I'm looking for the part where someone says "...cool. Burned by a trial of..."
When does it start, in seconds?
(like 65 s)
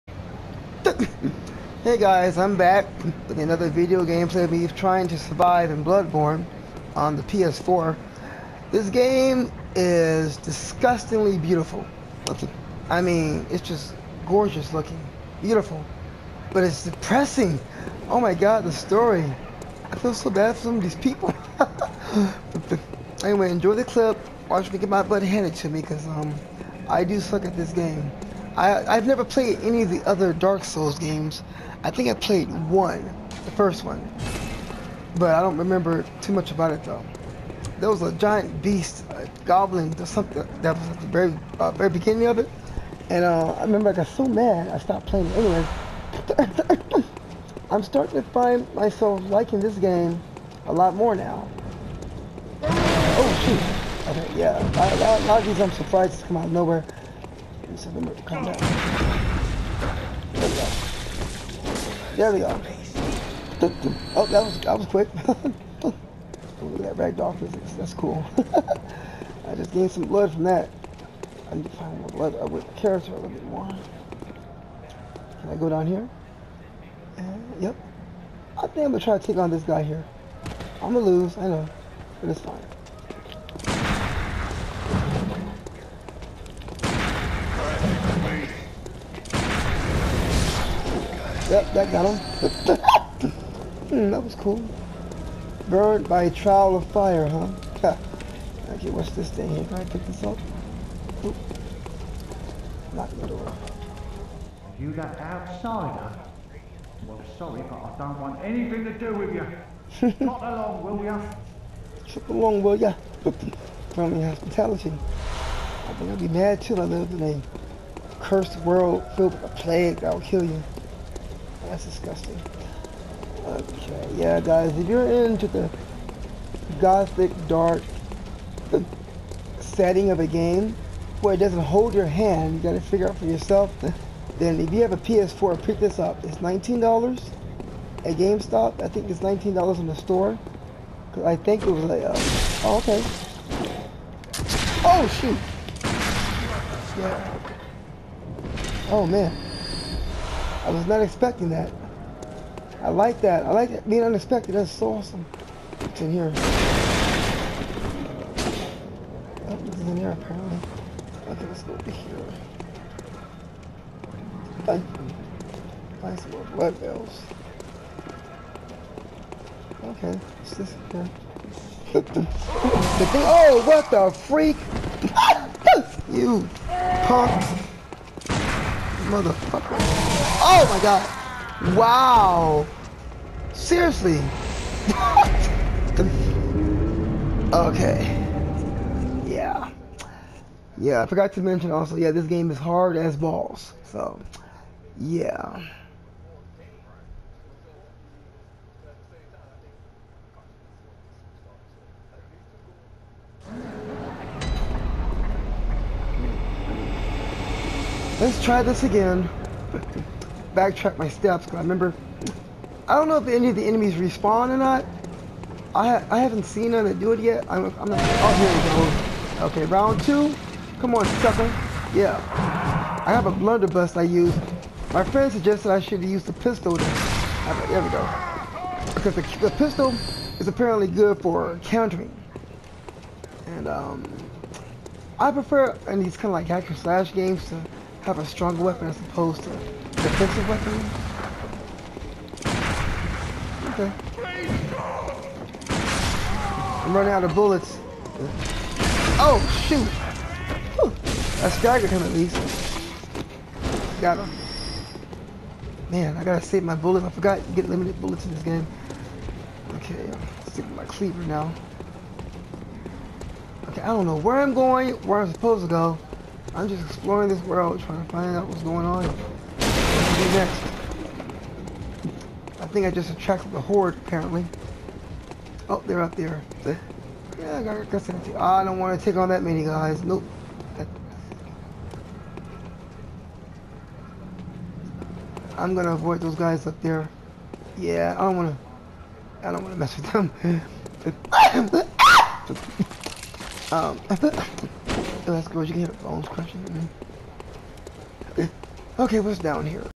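94 s.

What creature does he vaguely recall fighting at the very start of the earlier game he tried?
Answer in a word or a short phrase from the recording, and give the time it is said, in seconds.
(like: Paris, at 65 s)
goblin, at 39 s.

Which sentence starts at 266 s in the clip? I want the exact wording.
I'm just exploring this world, trying to find out what's going on.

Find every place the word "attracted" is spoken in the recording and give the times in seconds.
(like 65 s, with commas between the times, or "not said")
273 s.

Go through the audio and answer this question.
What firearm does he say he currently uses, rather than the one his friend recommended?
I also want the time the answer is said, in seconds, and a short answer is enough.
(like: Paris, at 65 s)
blunderbuss, at 223 s.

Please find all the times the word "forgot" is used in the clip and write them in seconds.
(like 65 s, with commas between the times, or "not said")
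191 s, 257 s.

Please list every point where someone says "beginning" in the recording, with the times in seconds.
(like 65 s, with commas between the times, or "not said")
41 s.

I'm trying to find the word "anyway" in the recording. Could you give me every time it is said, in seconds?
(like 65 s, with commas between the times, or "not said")
23 s, 45 s.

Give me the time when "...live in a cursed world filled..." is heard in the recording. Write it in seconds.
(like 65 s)
116 s.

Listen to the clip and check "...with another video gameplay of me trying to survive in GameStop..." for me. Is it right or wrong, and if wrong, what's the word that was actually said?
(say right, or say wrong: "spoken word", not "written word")
wrong: "Bloodborne", not "GameStop".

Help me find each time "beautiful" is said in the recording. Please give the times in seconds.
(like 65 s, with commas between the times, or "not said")
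11 s, 15 s.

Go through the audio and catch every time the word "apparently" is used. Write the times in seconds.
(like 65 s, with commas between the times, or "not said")
160 s, 230 s, 274 s.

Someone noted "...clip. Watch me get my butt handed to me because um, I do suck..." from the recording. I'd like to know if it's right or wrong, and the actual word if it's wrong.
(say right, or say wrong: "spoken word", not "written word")
right.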